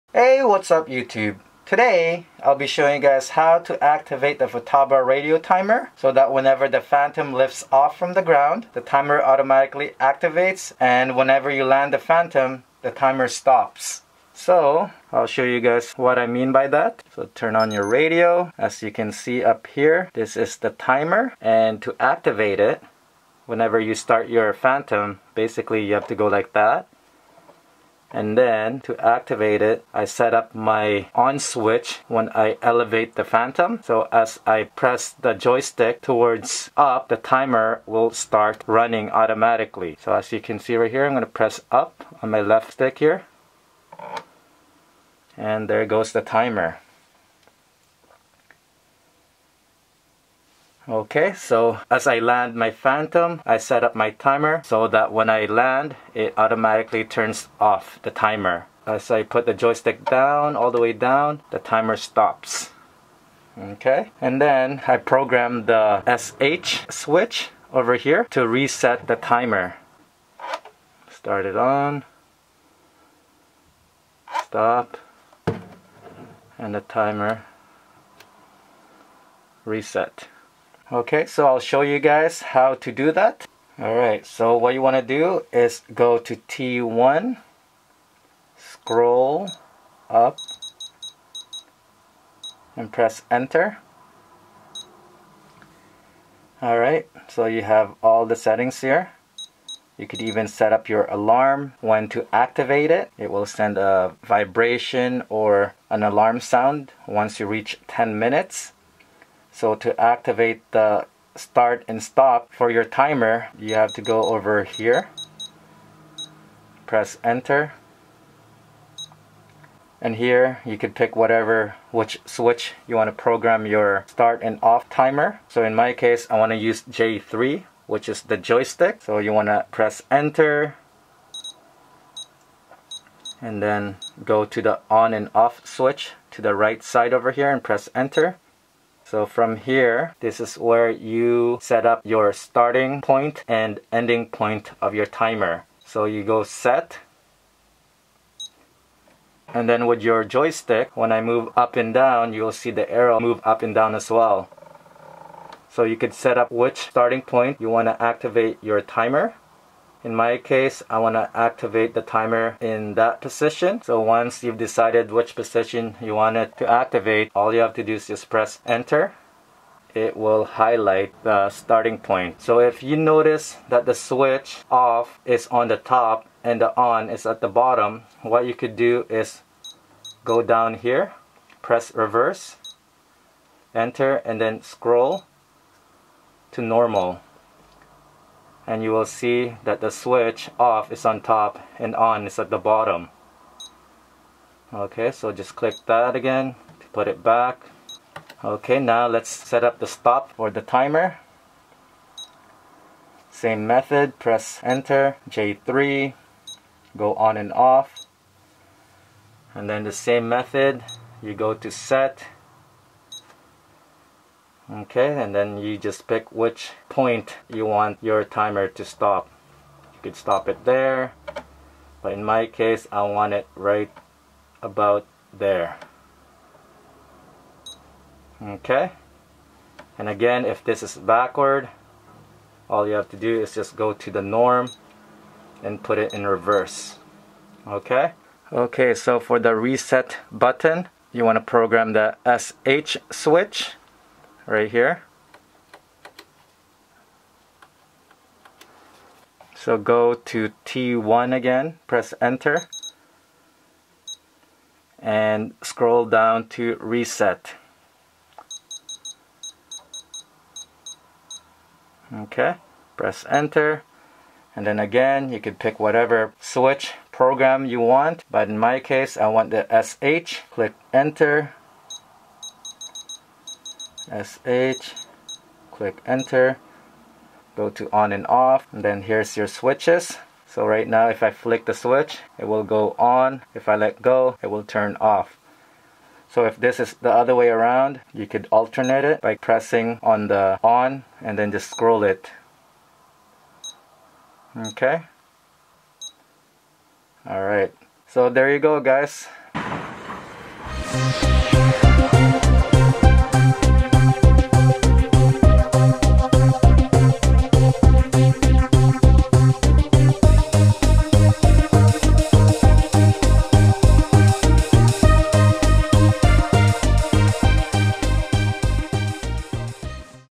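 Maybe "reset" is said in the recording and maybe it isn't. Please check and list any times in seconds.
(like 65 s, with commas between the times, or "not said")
68 s, 79 s, 239 s, 256 s.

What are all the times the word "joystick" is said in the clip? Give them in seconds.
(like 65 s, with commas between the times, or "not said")
35 s, 59 s, 128 s, 150 s.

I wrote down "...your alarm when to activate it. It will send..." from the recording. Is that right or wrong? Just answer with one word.
right.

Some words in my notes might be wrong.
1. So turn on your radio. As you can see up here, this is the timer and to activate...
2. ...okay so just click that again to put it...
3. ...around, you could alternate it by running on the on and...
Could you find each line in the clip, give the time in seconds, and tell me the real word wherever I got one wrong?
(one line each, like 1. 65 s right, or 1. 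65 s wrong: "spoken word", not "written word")
1. 17 s right
2. 194 s right
3. 287 s wrong: "pressing", not "running".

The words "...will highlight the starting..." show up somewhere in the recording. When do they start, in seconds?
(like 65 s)
170 s.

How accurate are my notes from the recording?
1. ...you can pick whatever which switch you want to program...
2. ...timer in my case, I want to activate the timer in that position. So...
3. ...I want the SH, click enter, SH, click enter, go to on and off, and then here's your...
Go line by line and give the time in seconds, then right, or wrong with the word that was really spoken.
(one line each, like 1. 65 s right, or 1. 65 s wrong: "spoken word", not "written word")
1. 120 s right
2. 158 s right
3. 269 s right.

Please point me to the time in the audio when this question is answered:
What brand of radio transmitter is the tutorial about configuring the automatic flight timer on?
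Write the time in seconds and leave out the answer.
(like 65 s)
4 s.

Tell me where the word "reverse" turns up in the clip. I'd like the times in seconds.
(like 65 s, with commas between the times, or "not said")
181 s, 236 s.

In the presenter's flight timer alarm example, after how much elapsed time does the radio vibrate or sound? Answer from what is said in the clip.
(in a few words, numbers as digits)
10 minutes.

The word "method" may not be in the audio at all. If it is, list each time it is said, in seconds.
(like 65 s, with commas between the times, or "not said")
203 s, 210 s.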